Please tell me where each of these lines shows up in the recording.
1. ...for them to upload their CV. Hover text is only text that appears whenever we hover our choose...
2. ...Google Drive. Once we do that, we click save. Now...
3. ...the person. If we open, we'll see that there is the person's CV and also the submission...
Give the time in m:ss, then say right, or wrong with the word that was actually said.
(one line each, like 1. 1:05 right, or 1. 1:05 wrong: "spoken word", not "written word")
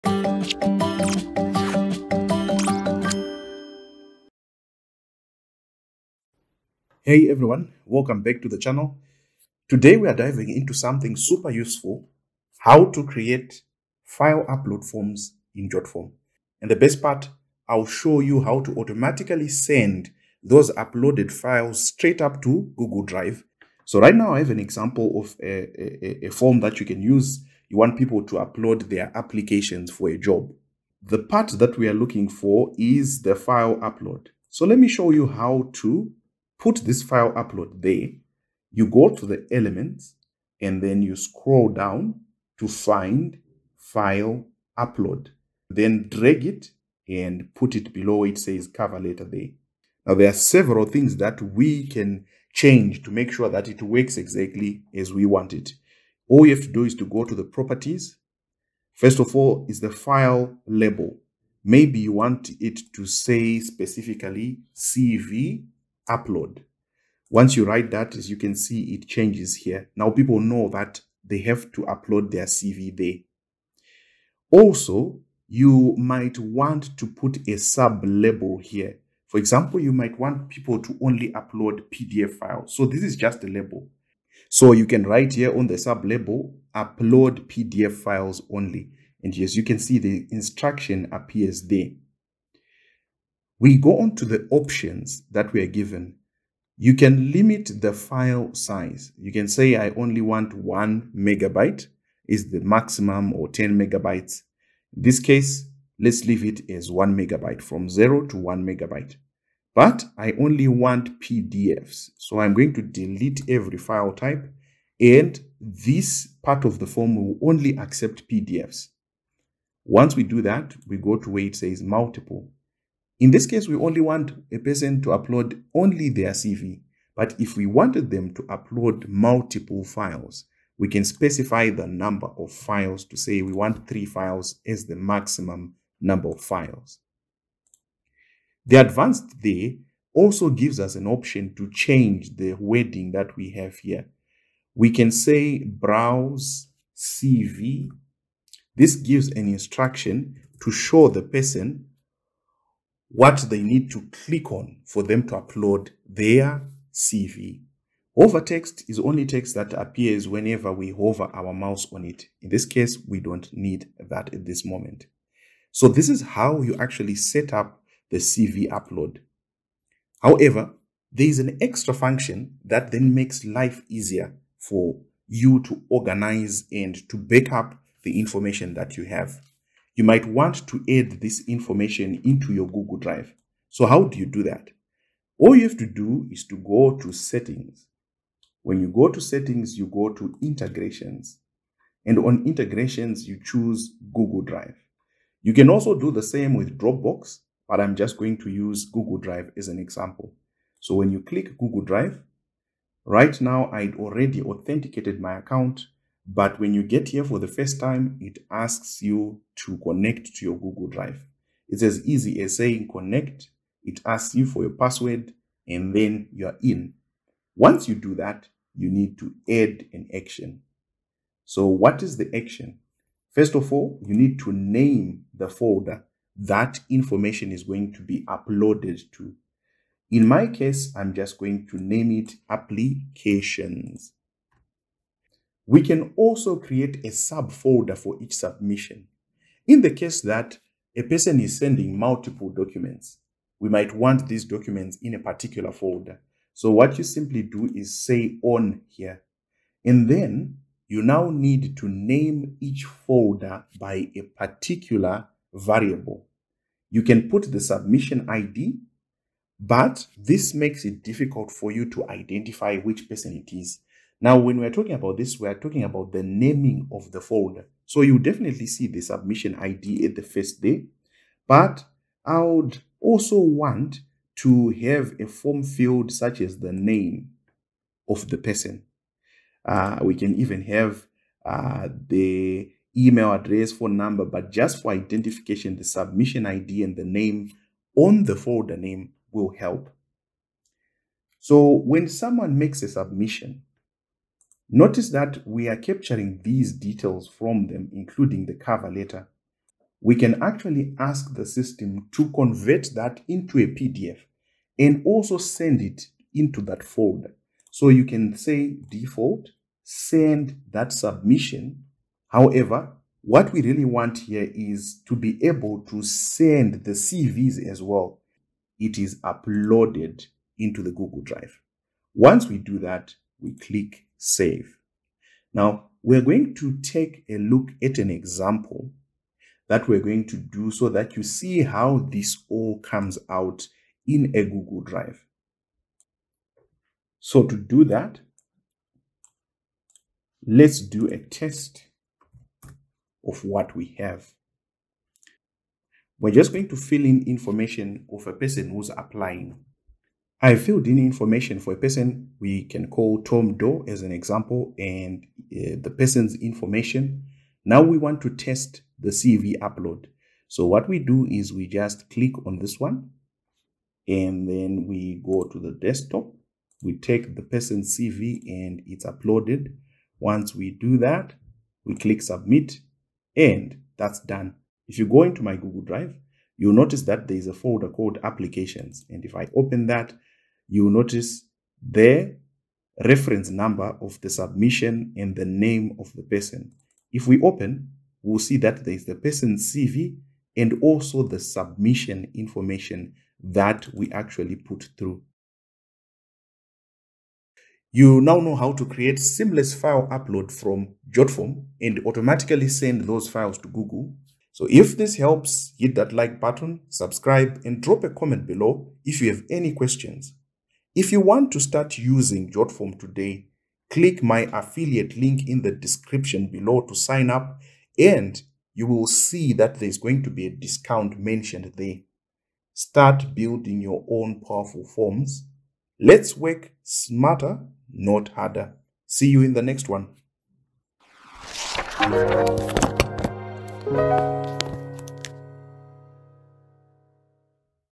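1. 2:34 wrong: "mouse", not "choose"
2. 5:20 right
3. 6:26 right.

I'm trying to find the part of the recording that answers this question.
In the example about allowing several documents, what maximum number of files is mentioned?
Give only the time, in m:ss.
2:13.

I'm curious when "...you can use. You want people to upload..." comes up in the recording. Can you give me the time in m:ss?
0:26.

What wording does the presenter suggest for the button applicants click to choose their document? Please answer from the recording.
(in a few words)
Browse CV.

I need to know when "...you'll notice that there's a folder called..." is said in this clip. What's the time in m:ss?
6:16.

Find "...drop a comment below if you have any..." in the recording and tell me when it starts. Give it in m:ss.
6:47.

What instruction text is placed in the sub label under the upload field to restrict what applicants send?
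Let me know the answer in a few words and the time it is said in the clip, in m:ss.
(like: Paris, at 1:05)
Upload PDF files only, at 1:26.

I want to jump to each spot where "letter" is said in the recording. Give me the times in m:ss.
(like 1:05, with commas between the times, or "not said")
0:48, 4:58.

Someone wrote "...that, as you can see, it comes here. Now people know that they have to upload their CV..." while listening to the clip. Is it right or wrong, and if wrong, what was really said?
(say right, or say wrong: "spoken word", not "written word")
wrong: "changes", not "comes".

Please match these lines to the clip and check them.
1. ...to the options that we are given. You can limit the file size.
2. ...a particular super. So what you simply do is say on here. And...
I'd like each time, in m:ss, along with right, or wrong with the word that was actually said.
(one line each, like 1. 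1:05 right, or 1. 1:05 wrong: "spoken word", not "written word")
1. 1:34 right
2. 4:05 wrong: "folder", not "super".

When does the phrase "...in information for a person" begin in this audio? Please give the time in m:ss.
5:50.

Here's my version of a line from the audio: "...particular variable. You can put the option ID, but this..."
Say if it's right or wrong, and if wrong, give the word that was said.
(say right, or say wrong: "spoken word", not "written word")
wrong: "submission", not "option".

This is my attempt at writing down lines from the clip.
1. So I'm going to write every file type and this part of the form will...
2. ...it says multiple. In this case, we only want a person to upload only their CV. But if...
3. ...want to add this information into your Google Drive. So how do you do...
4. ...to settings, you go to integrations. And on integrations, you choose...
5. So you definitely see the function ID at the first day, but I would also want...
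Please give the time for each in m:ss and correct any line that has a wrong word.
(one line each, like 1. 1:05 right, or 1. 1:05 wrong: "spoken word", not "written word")
1. 1:52 wrong: "delete", not "write"
2. 2:01 right
3. 3:00 right
4. 3:09 right
5. 4:27 wrong: "submission", not "function".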